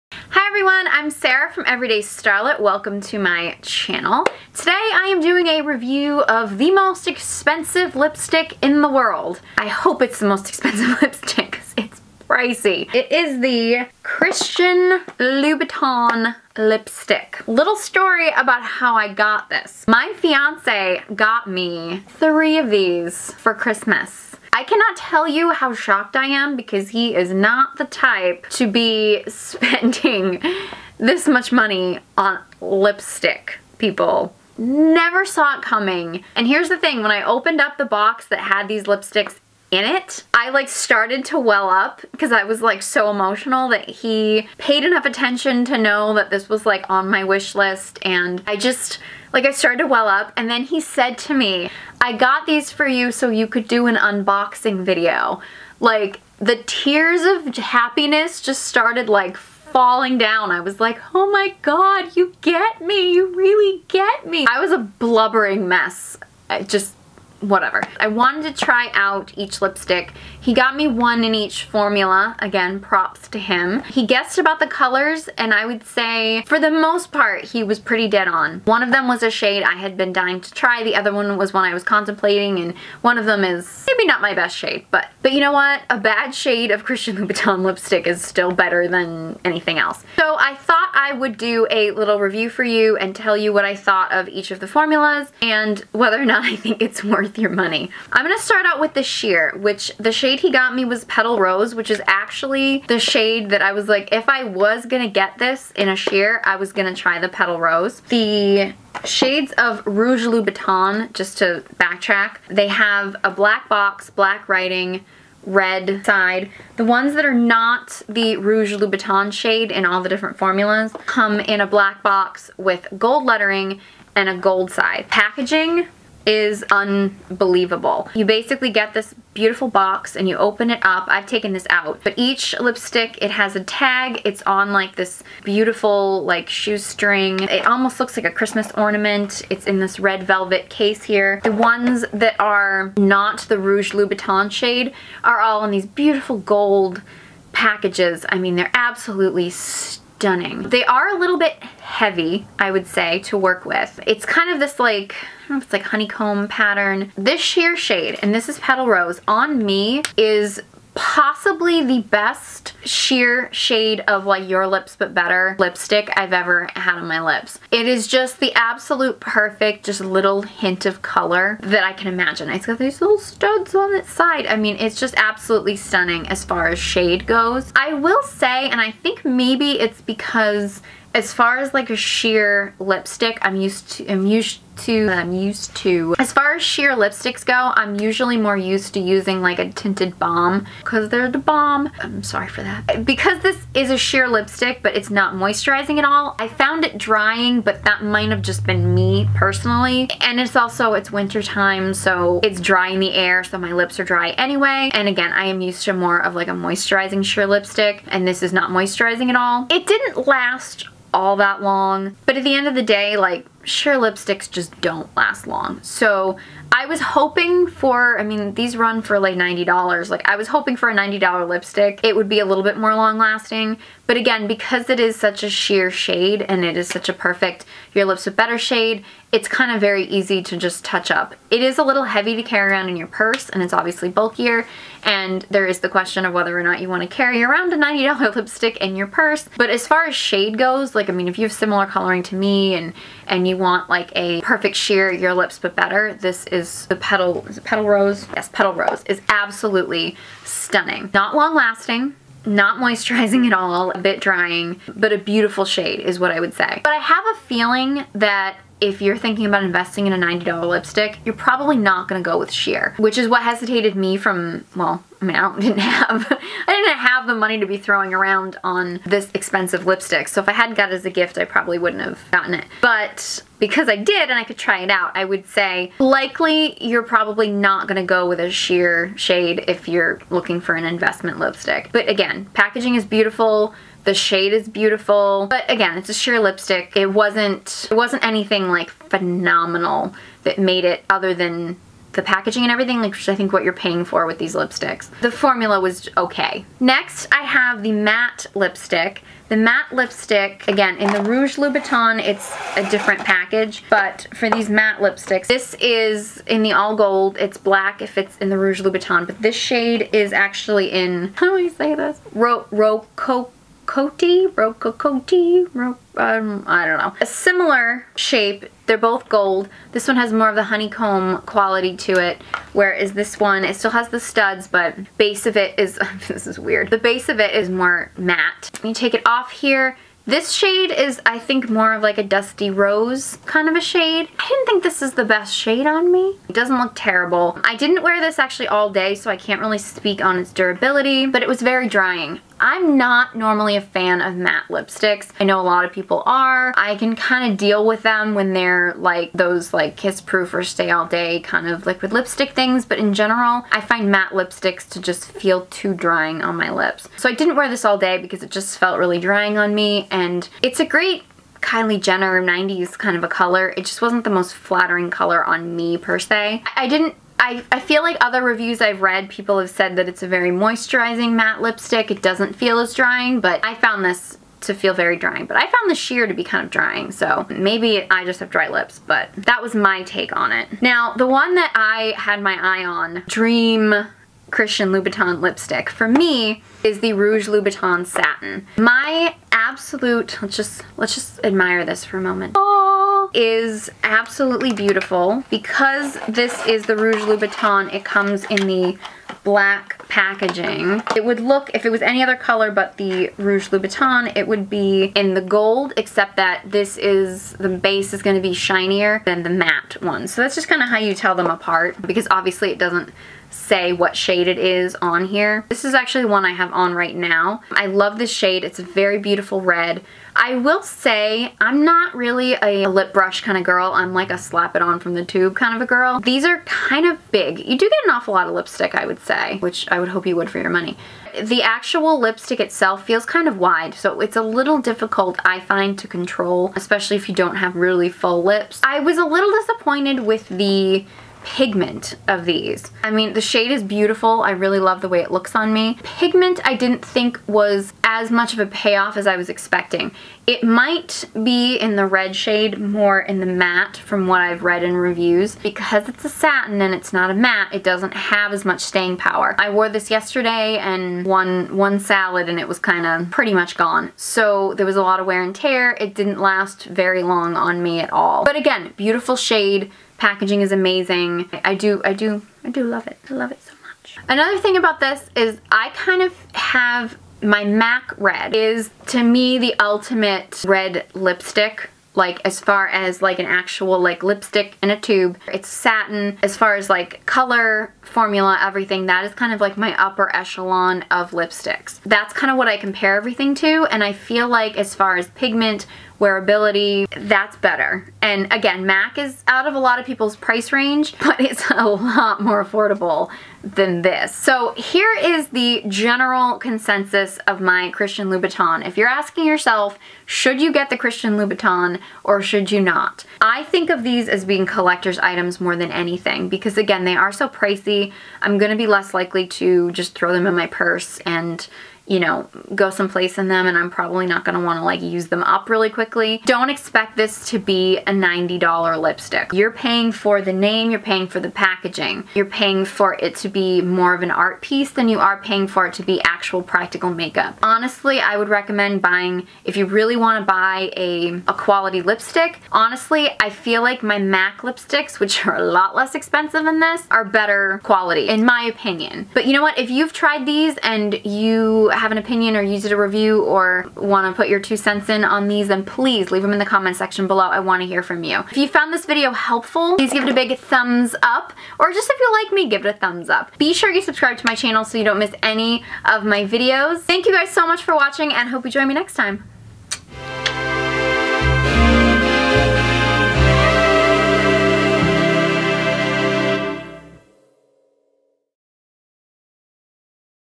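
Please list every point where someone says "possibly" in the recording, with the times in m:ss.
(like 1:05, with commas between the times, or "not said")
2:40.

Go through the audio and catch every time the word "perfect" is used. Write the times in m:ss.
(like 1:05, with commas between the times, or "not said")
2:49, 3:47, 4:04.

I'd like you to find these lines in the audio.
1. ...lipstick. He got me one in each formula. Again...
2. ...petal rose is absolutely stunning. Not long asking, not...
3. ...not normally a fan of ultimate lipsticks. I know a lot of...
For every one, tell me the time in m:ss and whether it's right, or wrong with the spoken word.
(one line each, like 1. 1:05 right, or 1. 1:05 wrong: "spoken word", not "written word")
1. 1:09 right
2. 4:08 wrong: "lasting", not "asking"
3. 5:42 wrong: "matte", not "ultimate".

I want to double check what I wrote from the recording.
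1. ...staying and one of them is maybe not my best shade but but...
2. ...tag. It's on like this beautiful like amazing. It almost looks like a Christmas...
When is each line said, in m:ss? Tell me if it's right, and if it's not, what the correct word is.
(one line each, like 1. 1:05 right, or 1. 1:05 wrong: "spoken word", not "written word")
1. 1:21 wrong: "contemplating", not "staying"
2. 2:13 wrong: "shoestring", not "amazing".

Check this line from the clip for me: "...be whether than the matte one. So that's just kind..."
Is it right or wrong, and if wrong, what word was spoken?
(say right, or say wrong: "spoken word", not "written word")
wrong: "shinier", not "whether".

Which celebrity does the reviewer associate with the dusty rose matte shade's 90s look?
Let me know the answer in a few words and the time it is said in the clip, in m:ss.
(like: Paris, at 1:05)
Kylie Jenner, at 6:01.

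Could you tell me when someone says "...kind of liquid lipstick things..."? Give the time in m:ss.
5:51.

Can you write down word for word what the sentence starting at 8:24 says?
So here is the general consensus of my Christian Louboutin.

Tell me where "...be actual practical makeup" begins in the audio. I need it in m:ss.
8:56.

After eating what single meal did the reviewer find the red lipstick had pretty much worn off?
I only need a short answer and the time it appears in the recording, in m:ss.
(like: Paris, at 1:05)
one salad, at 7:41.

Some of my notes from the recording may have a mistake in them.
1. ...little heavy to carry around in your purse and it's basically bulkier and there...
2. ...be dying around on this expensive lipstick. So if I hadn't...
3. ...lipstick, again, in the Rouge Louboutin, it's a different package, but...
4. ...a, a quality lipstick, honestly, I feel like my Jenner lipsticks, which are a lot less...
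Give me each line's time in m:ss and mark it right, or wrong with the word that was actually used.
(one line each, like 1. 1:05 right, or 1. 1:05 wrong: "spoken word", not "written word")
1. 3:51 wrong: "obviously", not "basically"
2. 4:27 wrong: "throwing", not "dying"
3. 4:59 right
4. 9:00 wrong: "MAC", not "Jenner".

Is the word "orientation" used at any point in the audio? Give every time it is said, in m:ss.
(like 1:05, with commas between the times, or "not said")
not said.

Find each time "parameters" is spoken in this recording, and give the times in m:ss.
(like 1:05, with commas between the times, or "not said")
not said.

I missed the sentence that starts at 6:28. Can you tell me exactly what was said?
My absolute, let's just, let's just admire this for a moment.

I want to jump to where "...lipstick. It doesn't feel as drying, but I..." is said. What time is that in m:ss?
6:11.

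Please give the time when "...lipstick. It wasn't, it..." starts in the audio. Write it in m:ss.
4:46.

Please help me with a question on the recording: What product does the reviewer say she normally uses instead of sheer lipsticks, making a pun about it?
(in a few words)
tinted balm.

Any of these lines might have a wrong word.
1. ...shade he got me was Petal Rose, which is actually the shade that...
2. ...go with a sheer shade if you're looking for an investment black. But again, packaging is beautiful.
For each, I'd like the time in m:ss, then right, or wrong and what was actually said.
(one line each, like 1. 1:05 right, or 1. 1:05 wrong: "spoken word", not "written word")
1. 1:40 right
2. 4:38 wrong: "lipstick", not "black".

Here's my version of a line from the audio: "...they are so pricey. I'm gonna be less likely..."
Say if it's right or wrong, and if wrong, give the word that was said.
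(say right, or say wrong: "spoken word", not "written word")
right.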